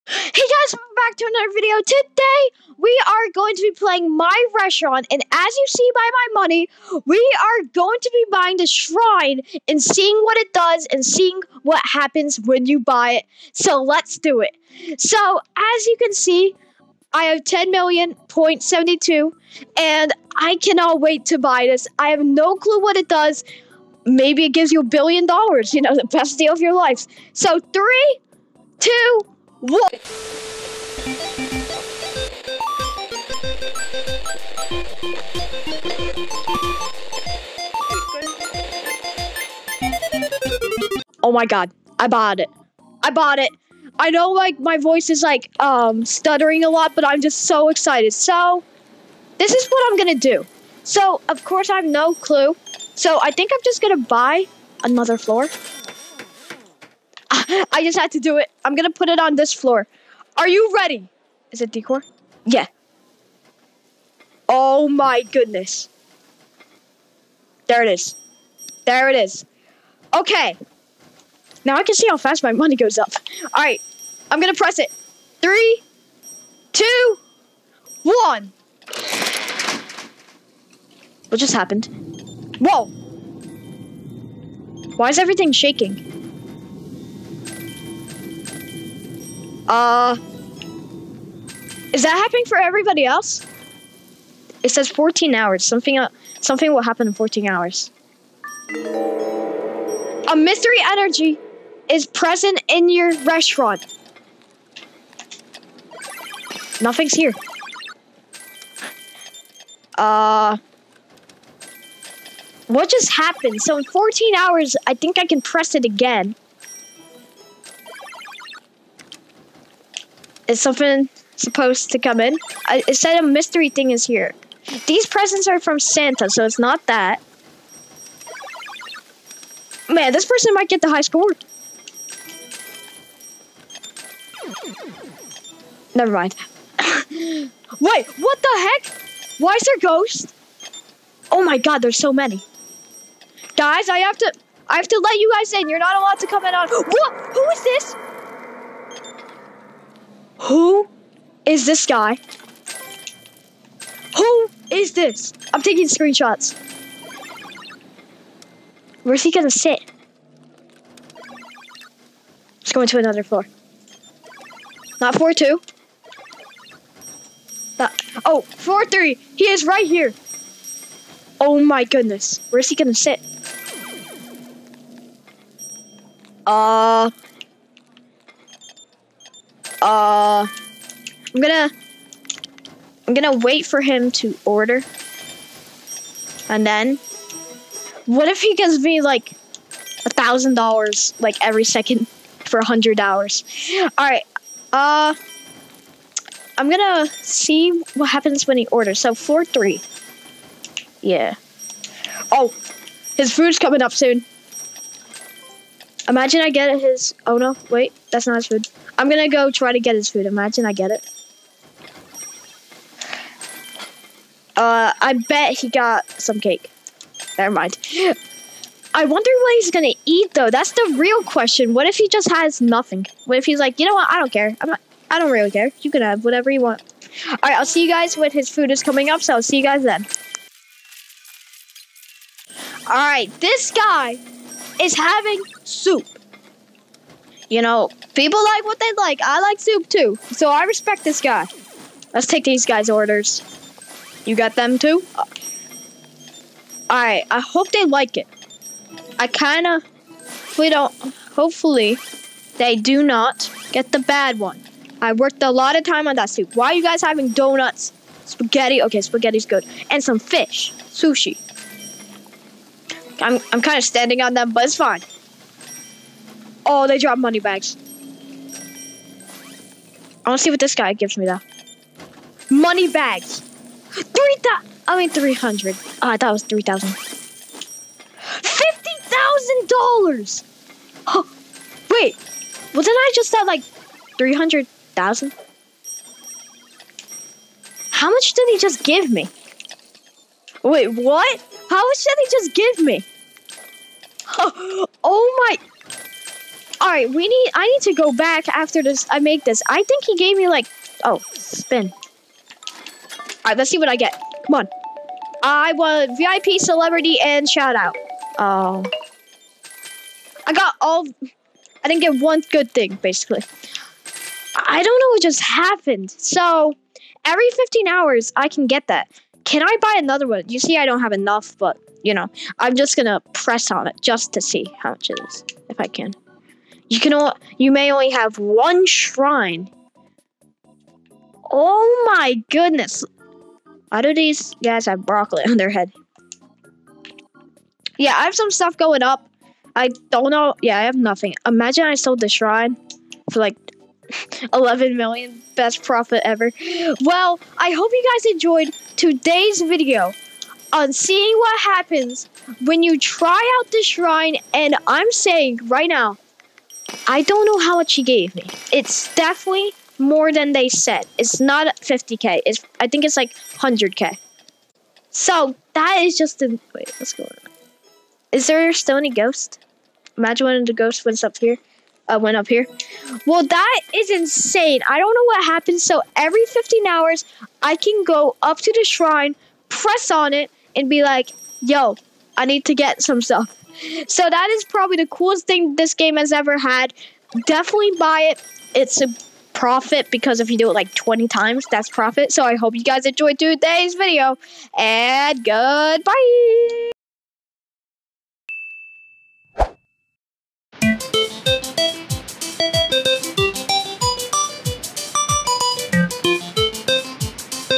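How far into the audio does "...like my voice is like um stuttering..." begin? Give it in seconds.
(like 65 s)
44 s.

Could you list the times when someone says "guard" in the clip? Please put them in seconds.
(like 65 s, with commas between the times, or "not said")
not said.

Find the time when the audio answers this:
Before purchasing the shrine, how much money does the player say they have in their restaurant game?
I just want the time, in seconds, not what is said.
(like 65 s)
17 s.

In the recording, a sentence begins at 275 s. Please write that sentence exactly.
Oh, ah, I thought it was 3,000.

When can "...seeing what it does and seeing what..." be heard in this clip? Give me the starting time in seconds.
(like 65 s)
9 s.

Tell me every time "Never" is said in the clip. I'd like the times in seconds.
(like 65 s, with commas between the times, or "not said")
135 s, 217 s.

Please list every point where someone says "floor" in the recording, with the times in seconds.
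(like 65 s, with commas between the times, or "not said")
55 s, 59 s, 163 s.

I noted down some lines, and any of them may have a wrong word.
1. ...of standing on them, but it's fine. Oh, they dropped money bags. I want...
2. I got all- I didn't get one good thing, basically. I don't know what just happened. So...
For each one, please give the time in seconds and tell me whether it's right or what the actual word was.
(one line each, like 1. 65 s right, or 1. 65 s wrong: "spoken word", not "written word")
1. 263 s right
2. 310 s right.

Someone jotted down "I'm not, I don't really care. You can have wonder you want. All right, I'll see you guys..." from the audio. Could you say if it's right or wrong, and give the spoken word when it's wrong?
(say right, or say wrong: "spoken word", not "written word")
wrong: "whatever", not "wonder".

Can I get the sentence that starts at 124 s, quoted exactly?
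These presents are from Santa, so it's not that.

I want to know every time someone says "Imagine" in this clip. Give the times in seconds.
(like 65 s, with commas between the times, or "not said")
206 s, 210 s, 341 s, 370 s.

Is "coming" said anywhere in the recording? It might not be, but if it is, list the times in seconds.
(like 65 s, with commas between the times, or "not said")
203 s, 228 s.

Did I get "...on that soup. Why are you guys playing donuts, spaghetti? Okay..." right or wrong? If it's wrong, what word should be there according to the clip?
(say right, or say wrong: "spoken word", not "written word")
wrong: "having", not "playing".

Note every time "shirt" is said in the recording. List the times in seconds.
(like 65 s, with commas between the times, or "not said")
not said.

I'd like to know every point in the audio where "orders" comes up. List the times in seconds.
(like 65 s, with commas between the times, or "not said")
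184 s, 198 s, 242 s.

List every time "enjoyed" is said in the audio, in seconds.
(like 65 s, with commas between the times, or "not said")
348 s, 393 s.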